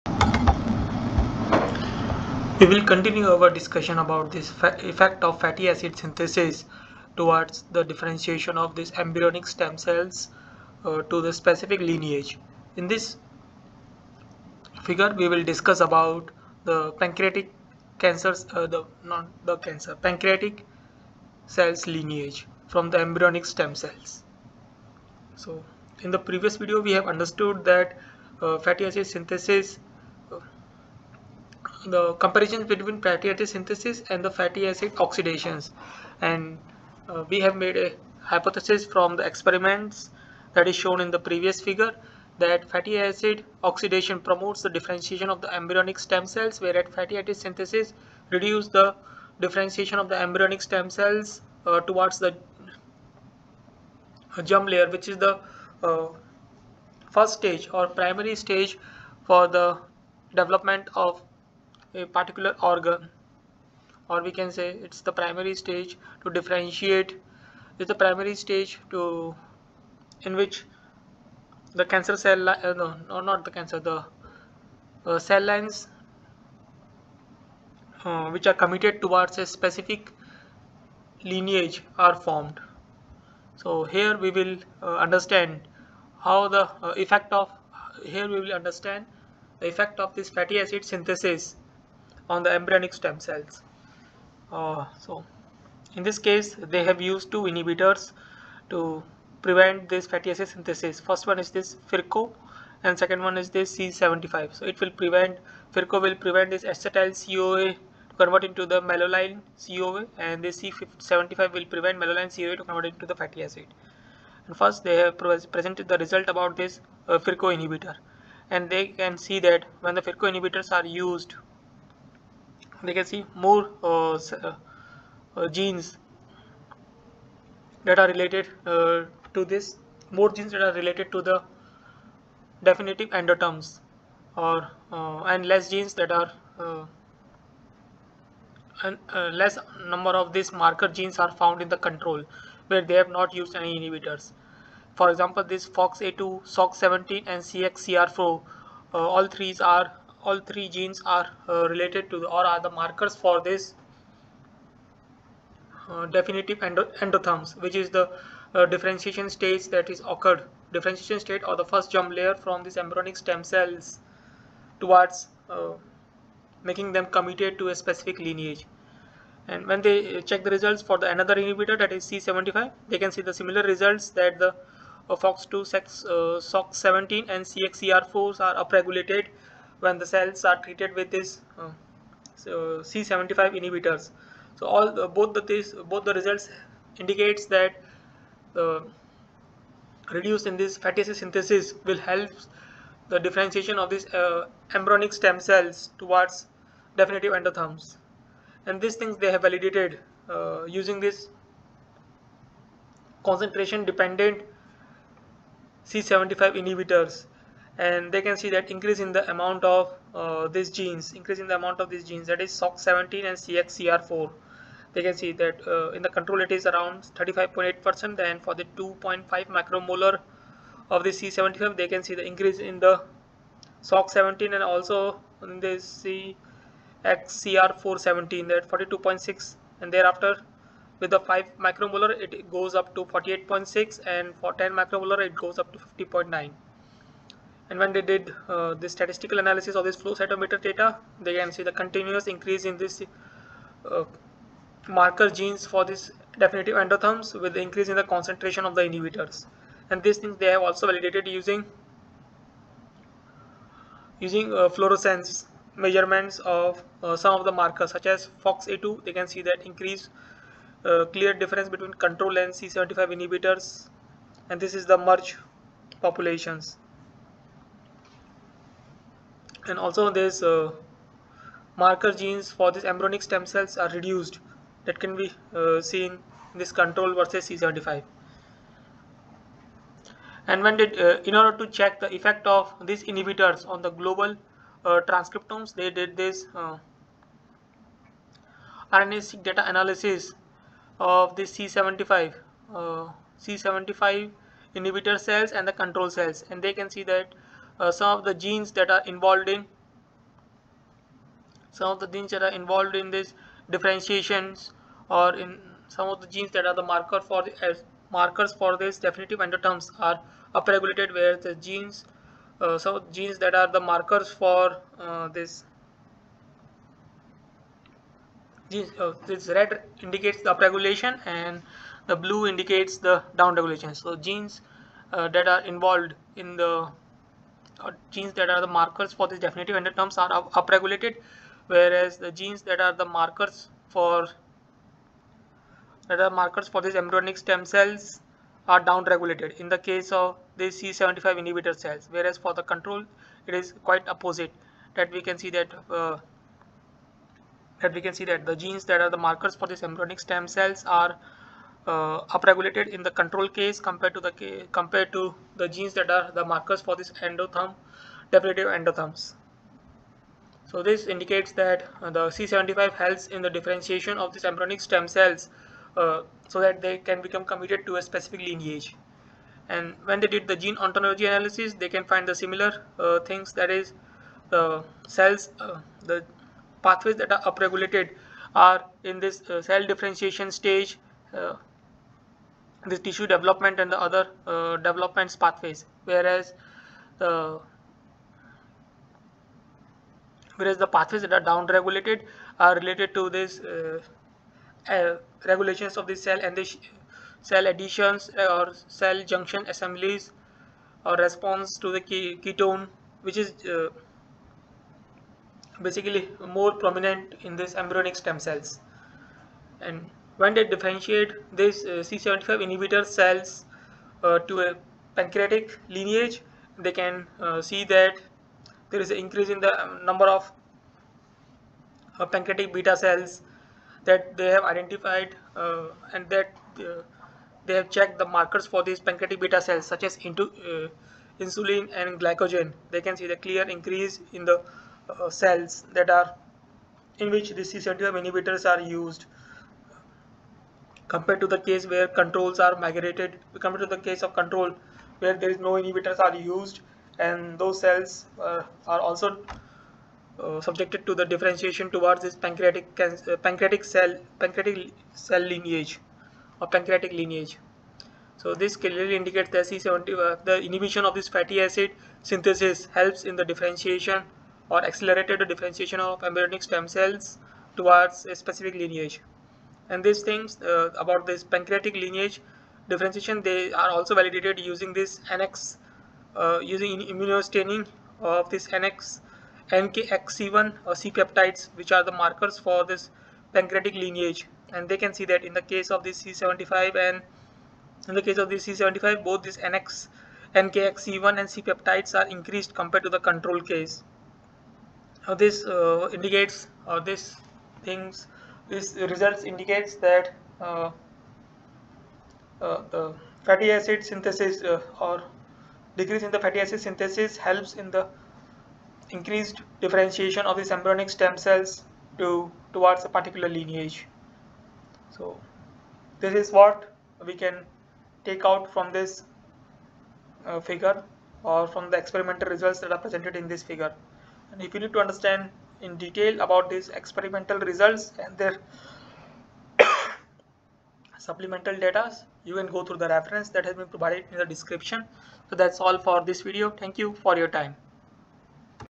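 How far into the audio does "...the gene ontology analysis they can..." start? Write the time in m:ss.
6:10.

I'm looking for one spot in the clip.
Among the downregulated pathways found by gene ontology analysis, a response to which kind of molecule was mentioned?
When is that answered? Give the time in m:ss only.
6:41.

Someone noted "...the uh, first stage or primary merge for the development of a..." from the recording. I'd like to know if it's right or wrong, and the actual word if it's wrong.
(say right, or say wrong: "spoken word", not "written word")
wrong: "stage", not "merge".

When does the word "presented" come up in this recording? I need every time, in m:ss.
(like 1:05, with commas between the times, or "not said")
1:55, 8:43.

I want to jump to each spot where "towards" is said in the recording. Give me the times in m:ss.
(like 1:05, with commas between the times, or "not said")
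0:07, 0:51, 1:19, 2:44, 3:15, 7:31, 7:47, 8:32.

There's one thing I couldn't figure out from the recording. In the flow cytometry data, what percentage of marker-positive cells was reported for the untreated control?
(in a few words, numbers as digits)
35.8%.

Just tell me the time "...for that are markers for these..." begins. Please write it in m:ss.
5:33.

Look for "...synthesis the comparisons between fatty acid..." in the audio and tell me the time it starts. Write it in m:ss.
0:29.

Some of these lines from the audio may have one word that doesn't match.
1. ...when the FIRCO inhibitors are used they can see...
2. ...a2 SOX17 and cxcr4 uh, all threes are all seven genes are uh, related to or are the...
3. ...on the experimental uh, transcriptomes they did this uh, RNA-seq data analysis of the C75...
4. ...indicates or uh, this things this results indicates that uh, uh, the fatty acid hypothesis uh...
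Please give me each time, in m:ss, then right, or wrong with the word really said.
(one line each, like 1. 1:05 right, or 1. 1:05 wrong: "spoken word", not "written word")
1. 1:59 right
2. 2:25 wrong: "three", not "seven"
3. 4:43 wrong: "global", not "experimental"
4. 8:16 wrong: "synthesis", not "hypothesis".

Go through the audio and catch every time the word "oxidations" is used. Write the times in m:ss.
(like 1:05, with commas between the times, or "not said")
0:34, 0:43.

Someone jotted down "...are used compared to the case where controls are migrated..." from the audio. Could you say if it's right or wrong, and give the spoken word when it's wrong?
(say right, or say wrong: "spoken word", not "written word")
right.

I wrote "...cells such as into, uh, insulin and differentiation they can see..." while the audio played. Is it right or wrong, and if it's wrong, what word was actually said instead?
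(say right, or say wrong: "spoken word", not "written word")
wrong: "glucagon", not "differentiation".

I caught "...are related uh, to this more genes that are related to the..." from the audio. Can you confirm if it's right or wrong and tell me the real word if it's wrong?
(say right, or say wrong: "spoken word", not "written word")
right.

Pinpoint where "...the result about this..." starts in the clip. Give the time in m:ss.
1:55.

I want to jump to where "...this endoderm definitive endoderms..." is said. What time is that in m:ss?
5:56.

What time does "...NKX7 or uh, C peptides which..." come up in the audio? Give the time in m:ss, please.
7:59.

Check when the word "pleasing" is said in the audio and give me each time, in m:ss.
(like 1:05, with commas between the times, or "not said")
not said.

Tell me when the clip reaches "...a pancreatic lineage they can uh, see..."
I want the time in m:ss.
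6:54.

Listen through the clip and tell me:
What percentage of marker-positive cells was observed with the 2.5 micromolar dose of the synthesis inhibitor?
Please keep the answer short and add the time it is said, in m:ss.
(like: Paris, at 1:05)
42.6%, at 3:48.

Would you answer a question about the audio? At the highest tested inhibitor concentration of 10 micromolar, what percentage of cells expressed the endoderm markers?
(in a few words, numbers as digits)
50.9%.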